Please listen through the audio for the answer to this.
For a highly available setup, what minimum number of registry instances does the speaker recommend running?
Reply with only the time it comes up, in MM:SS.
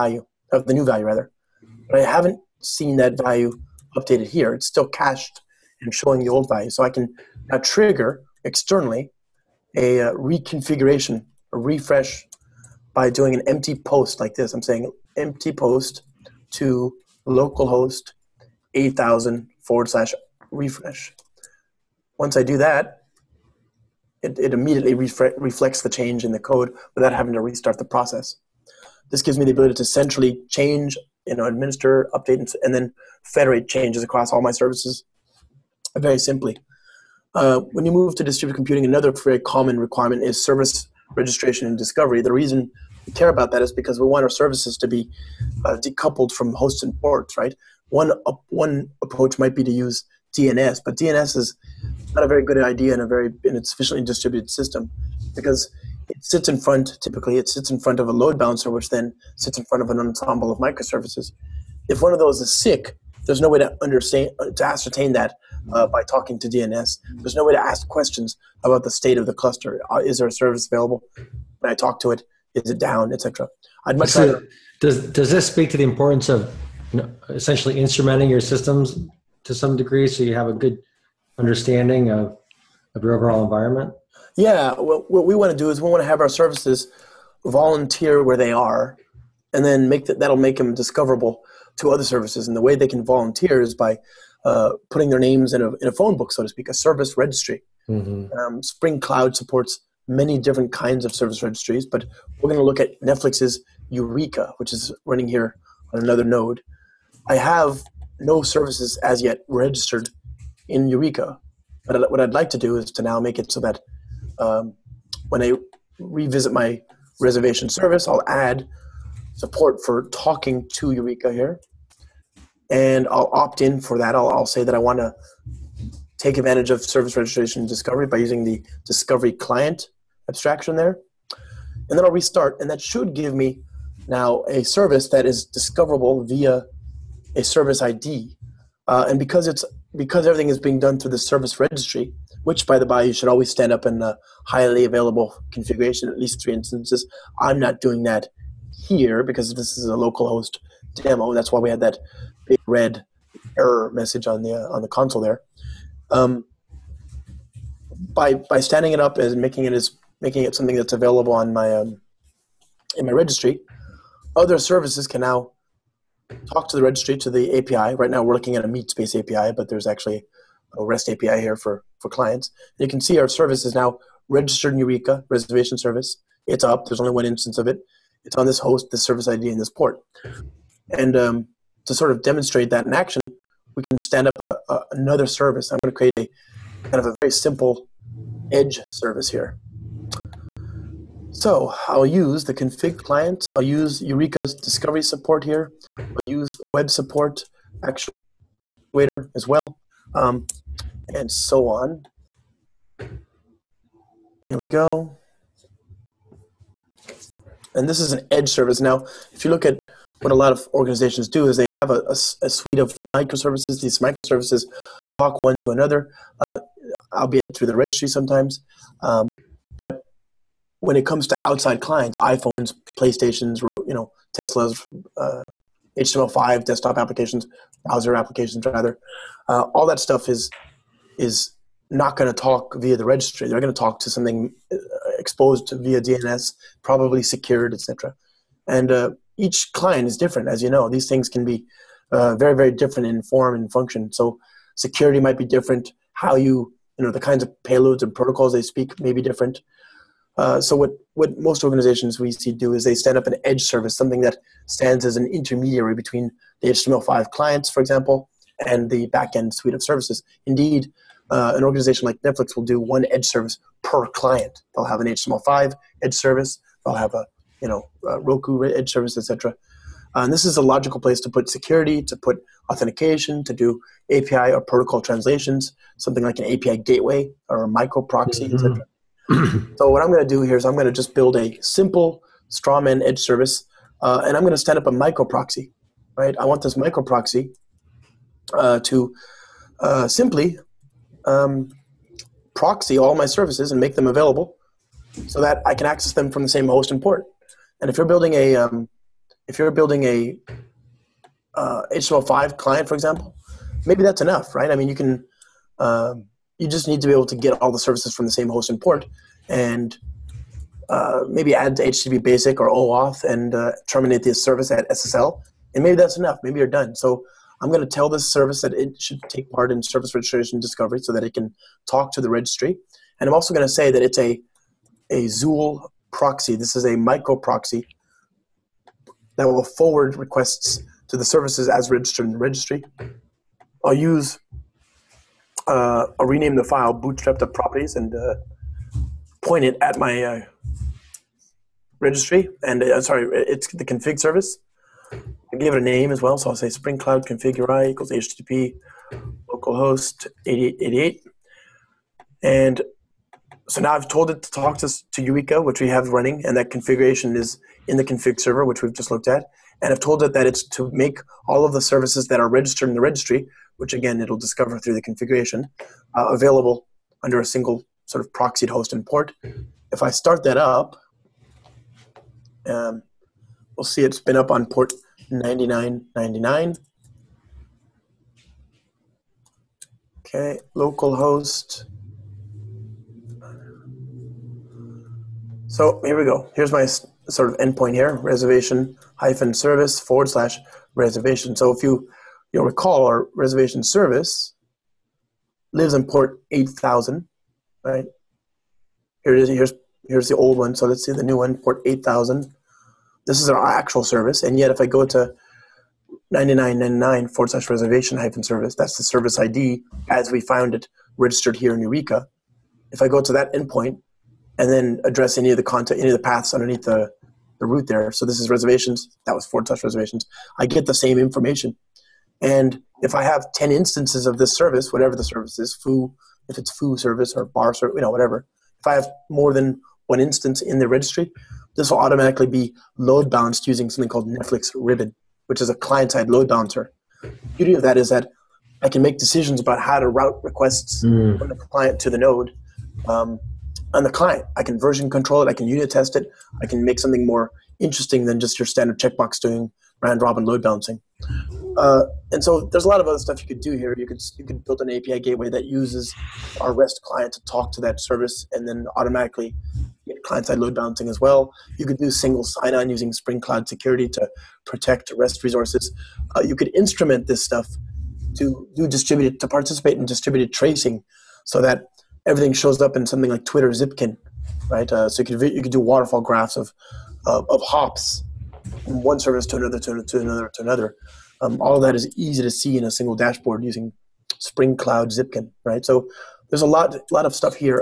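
02:26.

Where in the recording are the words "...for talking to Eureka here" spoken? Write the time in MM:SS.
01:59.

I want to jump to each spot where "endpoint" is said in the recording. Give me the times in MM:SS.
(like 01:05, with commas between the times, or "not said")
06:27, 06:53.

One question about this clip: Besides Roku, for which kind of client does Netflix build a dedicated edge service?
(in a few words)
HTML5.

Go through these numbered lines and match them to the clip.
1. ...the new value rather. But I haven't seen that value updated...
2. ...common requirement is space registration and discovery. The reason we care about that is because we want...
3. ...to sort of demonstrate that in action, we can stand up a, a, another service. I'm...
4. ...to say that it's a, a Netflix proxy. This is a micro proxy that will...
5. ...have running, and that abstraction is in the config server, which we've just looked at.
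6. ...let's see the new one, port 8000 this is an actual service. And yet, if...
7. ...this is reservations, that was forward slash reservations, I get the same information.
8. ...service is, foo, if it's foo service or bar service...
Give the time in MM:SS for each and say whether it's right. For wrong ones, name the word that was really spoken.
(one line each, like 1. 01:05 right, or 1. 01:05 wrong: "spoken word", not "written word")
1. 00:00 right
2. 00:39 wrong: "service", not "space"
3. 03:01 right
4. 05:23 wrong: "Zuul", not "Netflix"
5. 05:55 wrong: "configuration", not "abstraction"
6. 06:40 right
7. 06:58 right
8. 07:05 right.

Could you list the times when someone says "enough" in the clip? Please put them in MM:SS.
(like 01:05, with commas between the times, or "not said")
05:04, 05:16.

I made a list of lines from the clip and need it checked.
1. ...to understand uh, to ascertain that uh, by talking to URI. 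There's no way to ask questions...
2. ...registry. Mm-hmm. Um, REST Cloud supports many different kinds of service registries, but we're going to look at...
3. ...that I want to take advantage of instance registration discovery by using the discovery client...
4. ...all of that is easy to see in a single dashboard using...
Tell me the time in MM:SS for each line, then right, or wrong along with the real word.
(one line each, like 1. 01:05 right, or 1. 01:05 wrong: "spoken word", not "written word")
1. 01:03 wrong: "DNS", not "URI"
2. 01:37 wrong: "Spring", not "REST"
3. 02:04 wrong: "service", not "instance"
4. 08:01 right.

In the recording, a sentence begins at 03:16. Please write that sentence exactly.
I'll use web support actuator as well, um, and so on.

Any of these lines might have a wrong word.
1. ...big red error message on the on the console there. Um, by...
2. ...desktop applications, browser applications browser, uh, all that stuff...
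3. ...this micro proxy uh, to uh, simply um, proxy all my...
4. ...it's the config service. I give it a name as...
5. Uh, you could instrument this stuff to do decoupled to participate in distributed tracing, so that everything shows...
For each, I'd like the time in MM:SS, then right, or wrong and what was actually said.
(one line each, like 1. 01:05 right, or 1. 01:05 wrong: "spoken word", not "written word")
1. 02:32 right
2. 03:46 wrong: "rather", not "browser"
3. 04:46 right
4. 05:43 right
5. 07:46 wrong: "distributed", not "decoupled".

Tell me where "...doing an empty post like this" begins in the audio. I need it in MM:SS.
00:13.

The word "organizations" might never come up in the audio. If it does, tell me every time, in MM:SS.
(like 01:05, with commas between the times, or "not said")
03:30, 04:11, 04:21.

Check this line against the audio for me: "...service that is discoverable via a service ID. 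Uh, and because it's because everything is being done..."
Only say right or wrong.
right.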